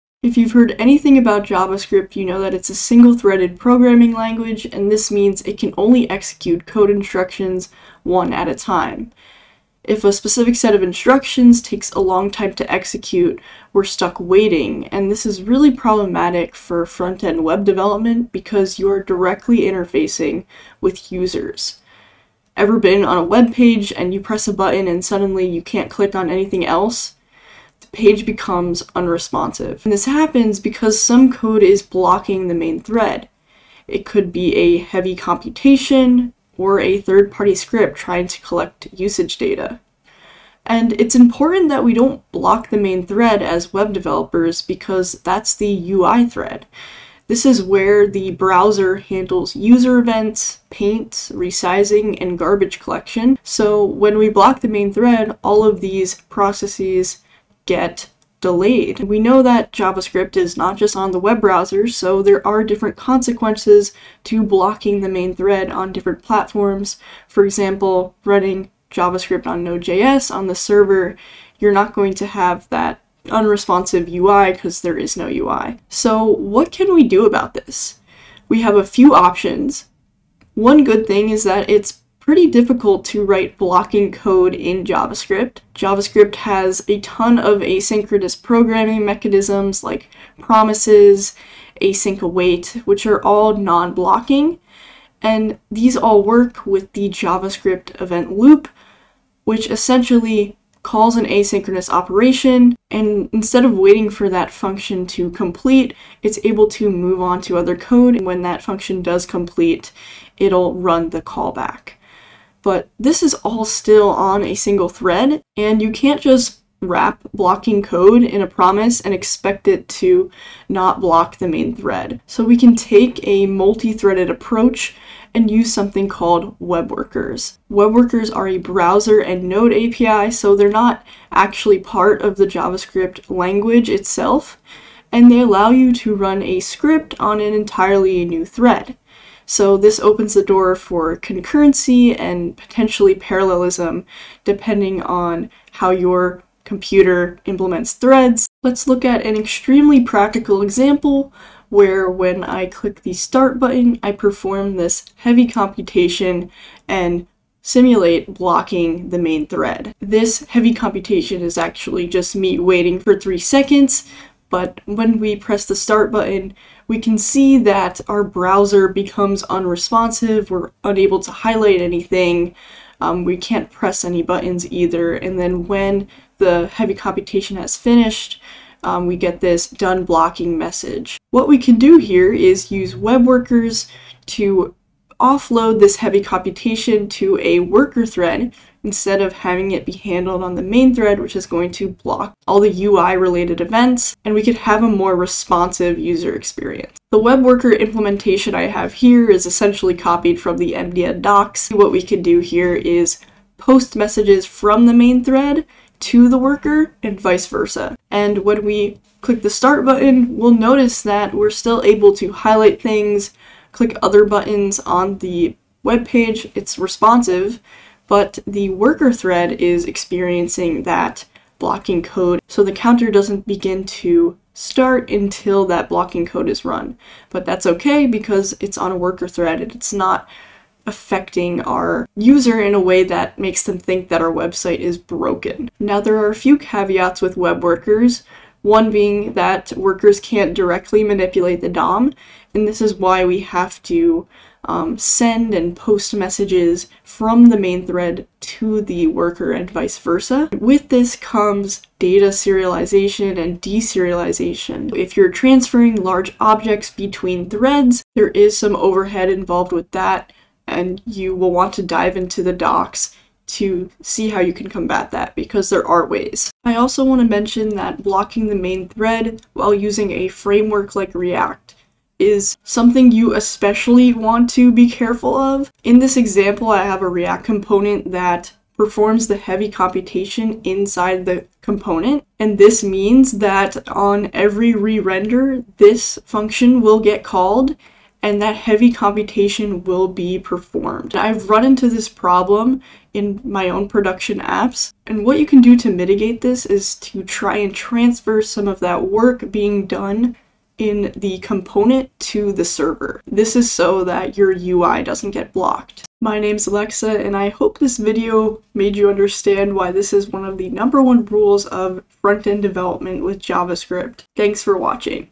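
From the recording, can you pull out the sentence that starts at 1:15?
So what can we do about this?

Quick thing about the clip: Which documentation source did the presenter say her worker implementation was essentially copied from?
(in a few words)
MDN docs.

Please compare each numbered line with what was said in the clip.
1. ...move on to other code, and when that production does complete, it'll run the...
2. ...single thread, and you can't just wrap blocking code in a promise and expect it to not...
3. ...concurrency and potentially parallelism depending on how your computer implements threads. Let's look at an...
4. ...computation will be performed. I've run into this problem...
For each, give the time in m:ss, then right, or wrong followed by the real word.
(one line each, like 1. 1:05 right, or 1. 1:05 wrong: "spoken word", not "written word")
1. 1:46 wrong: "function", not "production"
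2. 1:54 right
3. 2:21 right
4. 4:48 right.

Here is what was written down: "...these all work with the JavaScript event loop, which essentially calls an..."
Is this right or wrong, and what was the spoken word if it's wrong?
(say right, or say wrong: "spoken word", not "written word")
right.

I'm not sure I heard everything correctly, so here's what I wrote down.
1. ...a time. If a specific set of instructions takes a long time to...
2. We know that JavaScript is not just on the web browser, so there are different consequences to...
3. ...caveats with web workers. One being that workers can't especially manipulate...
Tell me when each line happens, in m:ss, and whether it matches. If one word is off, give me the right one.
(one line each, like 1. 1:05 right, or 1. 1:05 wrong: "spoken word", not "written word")
1. 0:08 right
2. 0:59 right
3. 3:56 wrong: "directly", not "especially".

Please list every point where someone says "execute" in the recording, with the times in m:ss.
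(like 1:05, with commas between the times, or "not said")
0:06, 0:12.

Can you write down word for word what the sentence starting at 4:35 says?
In this example, I have a React component that performs the heavy computation inside the component.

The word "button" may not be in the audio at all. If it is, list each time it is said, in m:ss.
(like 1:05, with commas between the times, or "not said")
0:24, 2:33, 2:46, 2:54, 3:29, 3:34.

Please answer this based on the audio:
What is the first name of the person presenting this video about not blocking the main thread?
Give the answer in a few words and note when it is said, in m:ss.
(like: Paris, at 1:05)
Alexa, at 5:06.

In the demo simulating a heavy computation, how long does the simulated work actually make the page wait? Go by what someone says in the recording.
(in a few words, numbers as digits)
3 seconds.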